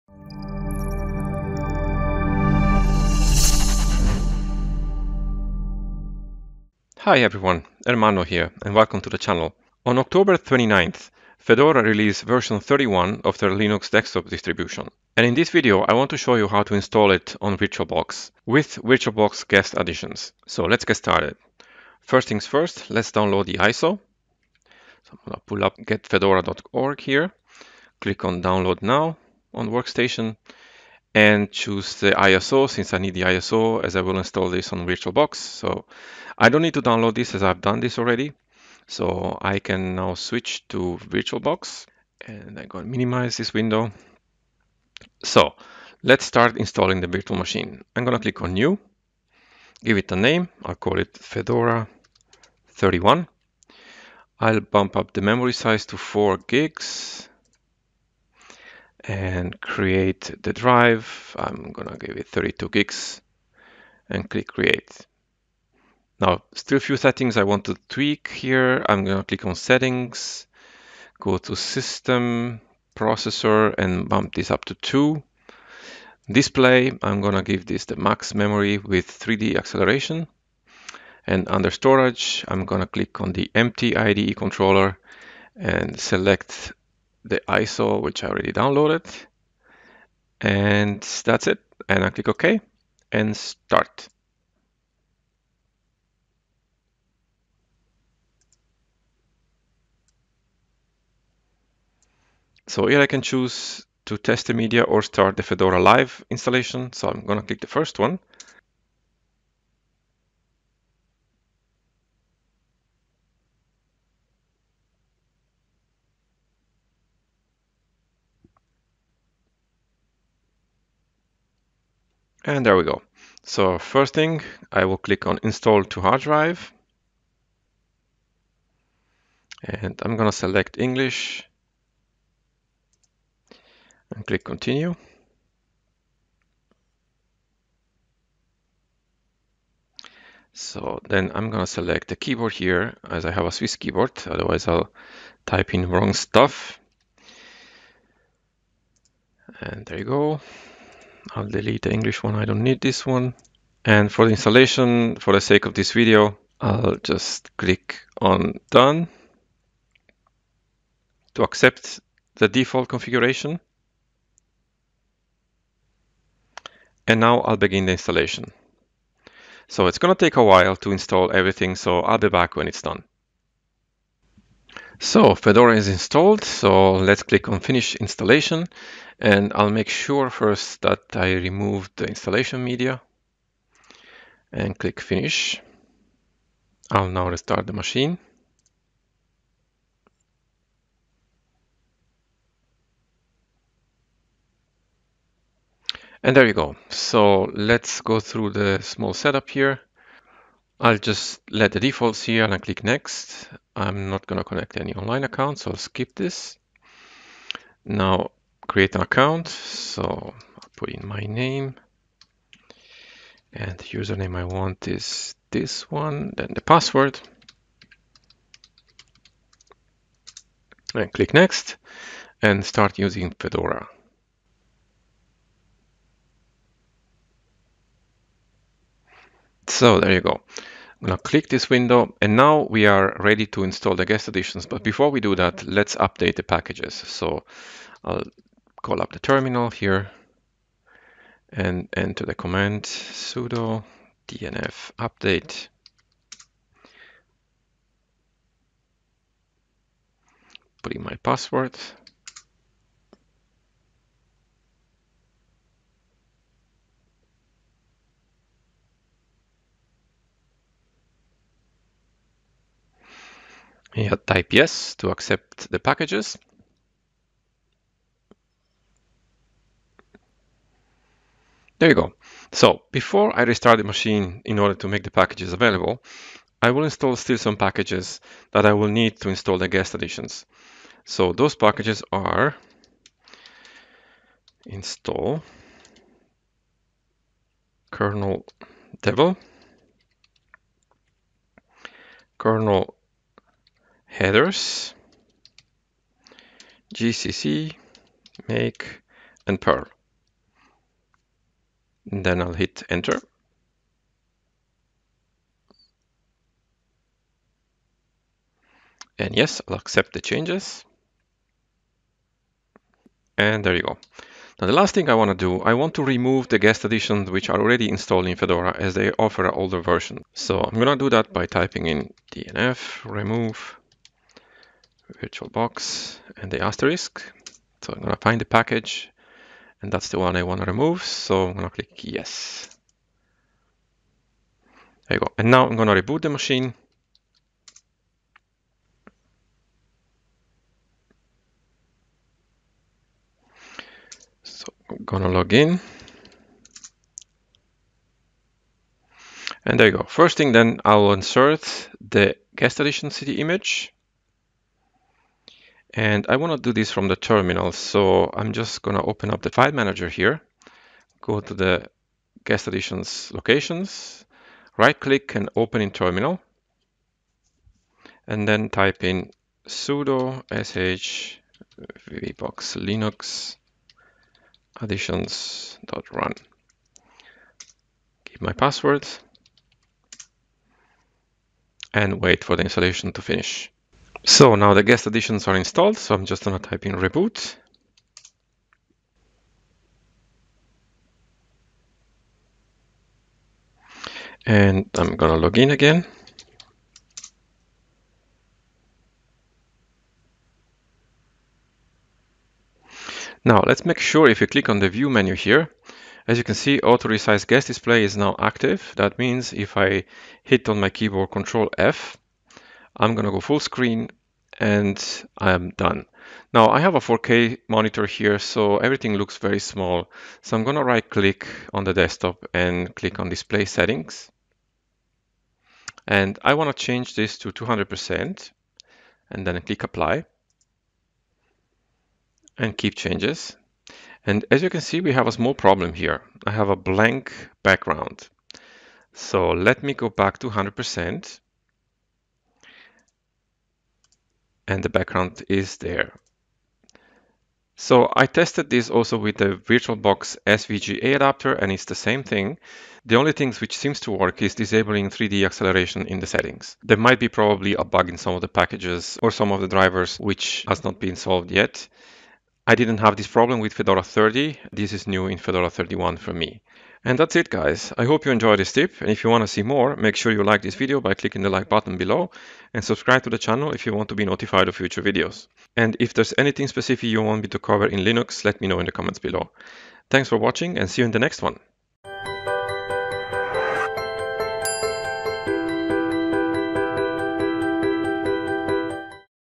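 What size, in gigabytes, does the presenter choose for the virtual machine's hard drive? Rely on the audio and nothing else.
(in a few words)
32.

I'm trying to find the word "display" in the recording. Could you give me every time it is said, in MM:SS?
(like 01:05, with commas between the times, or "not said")
01:16, 06:47, 07:03.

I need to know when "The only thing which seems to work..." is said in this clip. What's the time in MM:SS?
07:33.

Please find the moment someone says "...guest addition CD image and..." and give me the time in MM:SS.
05:52.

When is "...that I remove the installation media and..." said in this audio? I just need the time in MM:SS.
03:00.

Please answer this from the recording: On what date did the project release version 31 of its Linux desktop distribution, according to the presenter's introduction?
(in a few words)
October 29th.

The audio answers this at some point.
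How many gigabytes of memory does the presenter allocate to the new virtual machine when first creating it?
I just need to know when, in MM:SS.
00:55.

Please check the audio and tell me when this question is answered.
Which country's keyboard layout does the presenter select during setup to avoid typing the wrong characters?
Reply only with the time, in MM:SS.
02:23.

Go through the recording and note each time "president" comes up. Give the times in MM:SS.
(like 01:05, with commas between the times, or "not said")
not said.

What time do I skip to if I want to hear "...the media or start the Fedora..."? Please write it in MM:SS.
01:44.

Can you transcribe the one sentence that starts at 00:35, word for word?
So I don't need to download this as I've done this already.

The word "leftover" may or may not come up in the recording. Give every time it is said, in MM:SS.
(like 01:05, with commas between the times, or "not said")
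not said.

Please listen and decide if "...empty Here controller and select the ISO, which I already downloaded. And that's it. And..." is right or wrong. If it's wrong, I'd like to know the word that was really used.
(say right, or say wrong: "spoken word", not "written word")
wrong: "IDE", not "Here".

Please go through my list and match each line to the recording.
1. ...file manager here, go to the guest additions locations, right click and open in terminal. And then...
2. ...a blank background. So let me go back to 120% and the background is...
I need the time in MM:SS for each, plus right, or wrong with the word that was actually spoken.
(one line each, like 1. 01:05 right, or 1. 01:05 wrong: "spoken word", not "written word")
1. 05:59 right
2. 07:16 wrong: "100", not "120".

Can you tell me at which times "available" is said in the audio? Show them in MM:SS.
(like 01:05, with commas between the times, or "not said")
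04:35.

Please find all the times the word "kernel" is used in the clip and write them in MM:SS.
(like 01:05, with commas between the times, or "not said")
04:47, 04:52.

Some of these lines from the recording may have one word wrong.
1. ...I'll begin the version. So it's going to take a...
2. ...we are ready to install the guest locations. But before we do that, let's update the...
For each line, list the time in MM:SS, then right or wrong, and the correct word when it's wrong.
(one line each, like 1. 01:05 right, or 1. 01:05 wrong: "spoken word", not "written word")
1. 02:47 wrong: "installation", not "version"
2. 03:52 wrong: "additions", not "locations".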